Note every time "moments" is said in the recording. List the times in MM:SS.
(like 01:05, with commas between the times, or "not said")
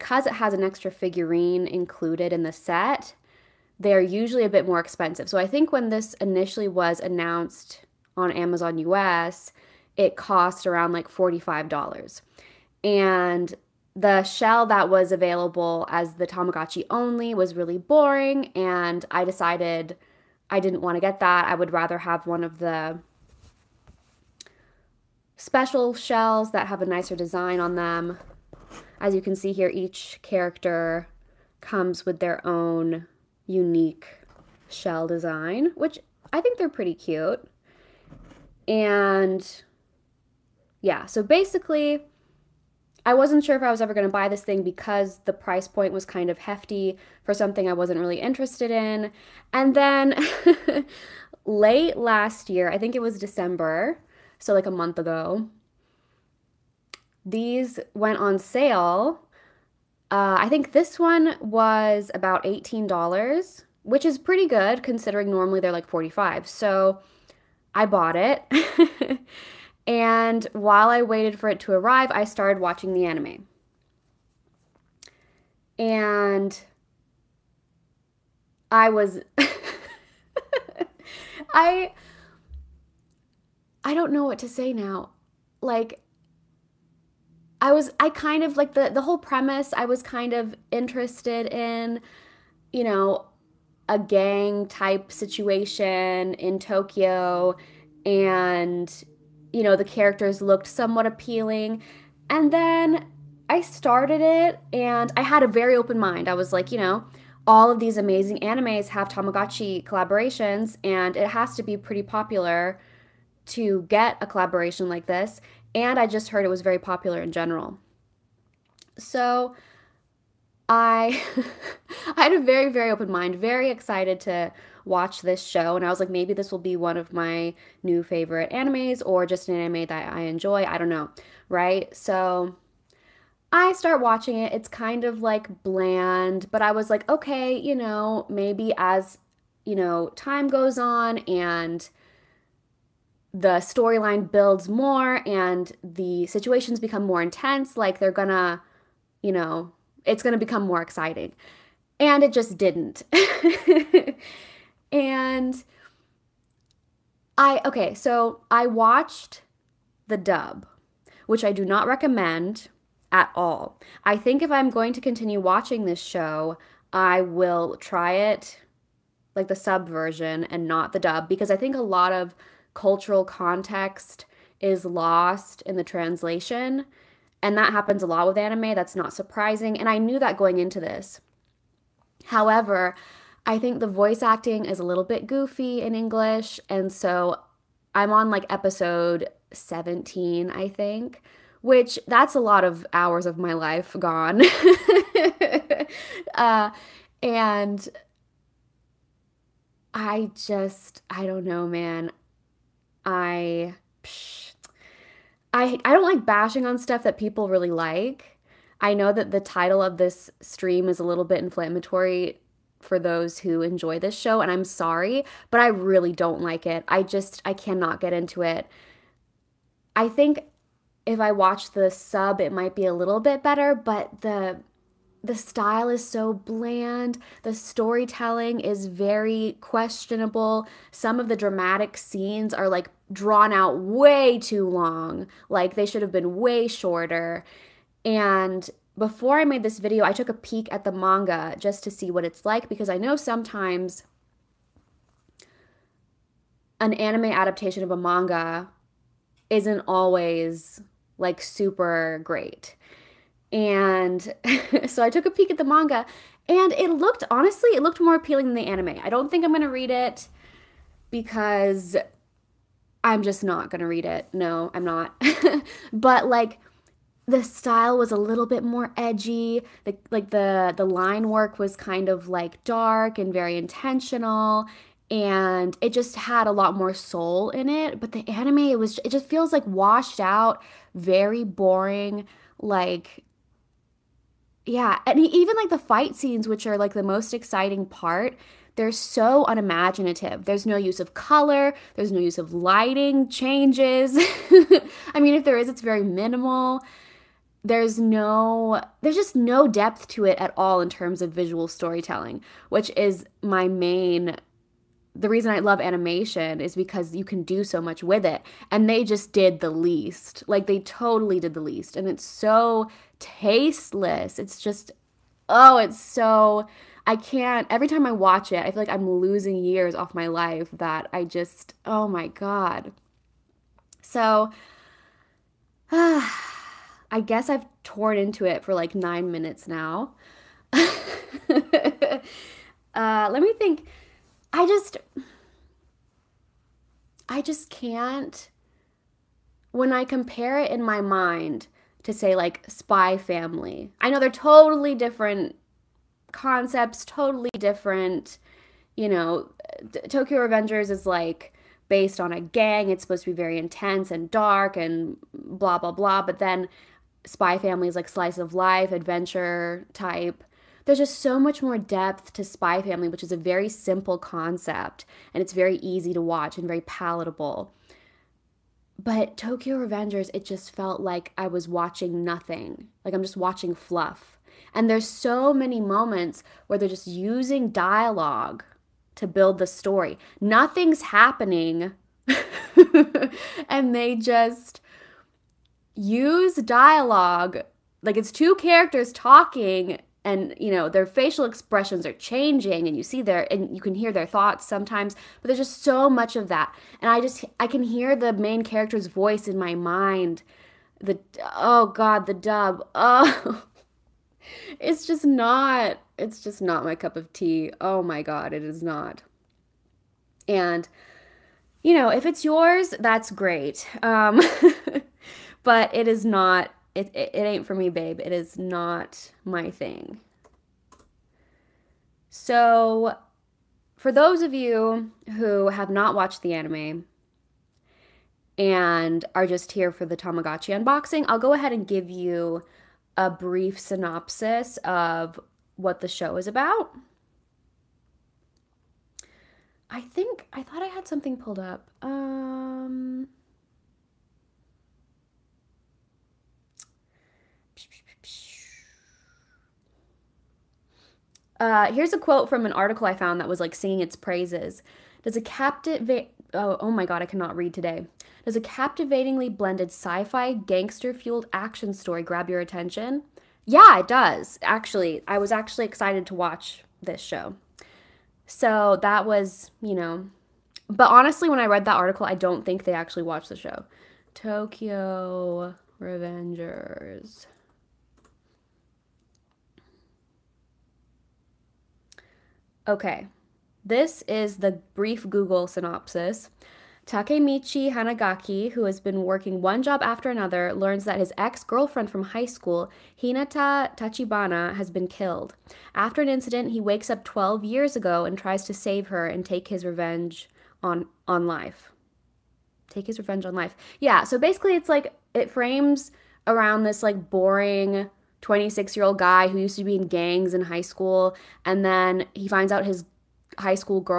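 06:15.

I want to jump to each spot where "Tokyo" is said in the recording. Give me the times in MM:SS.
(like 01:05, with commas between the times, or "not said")
01:36, 05:50, 06:09, 07:54.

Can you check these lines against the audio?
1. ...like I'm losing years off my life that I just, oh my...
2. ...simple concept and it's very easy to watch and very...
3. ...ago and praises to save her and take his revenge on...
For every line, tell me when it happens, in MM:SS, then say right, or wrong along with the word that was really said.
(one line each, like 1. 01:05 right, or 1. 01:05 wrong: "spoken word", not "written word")
1. 05:18 right
2. 06:03 right
3. 08:17 wrong: "tries", not "praises".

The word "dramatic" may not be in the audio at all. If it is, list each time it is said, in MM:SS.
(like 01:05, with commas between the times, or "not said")
03:51.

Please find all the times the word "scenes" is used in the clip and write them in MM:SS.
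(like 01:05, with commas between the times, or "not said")
03:51, 04:46.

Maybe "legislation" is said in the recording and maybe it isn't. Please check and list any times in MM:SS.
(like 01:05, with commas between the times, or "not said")
not said.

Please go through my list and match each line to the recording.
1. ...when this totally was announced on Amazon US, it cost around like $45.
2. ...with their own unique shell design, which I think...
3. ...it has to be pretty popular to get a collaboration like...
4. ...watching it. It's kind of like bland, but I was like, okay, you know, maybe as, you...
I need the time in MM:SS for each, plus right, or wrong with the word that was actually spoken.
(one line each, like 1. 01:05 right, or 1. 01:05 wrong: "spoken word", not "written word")
1. 00:05 wrong: "initially", not "totally"
2. 00:32 right
3. 01:51 right
4. 02:13 right.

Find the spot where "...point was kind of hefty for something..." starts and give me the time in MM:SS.
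00:45.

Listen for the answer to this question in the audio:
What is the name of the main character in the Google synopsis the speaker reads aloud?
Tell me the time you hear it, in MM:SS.
08:07.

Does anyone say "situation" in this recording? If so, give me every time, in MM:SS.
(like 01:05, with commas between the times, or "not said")
01:35, 02:26.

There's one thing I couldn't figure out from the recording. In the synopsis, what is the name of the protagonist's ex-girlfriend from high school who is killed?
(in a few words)
Hinata Tachibana.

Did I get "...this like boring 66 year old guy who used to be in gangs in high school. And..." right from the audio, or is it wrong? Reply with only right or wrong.
wrong.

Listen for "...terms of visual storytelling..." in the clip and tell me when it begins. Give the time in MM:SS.
05:00.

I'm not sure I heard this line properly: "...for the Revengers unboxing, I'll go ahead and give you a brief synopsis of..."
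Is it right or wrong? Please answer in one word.
wrong.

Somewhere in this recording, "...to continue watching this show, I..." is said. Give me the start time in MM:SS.
02:44.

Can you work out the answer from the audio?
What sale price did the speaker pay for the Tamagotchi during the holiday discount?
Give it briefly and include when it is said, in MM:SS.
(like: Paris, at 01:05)
$18, at 01:02.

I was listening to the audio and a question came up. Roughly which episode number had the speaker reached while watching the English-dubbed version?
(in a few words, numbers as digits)
17.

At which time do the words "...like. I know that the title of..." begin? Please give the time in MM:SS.
03:27.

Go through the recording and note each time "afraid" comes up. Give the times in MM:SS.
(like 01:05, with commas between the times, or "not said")
not said.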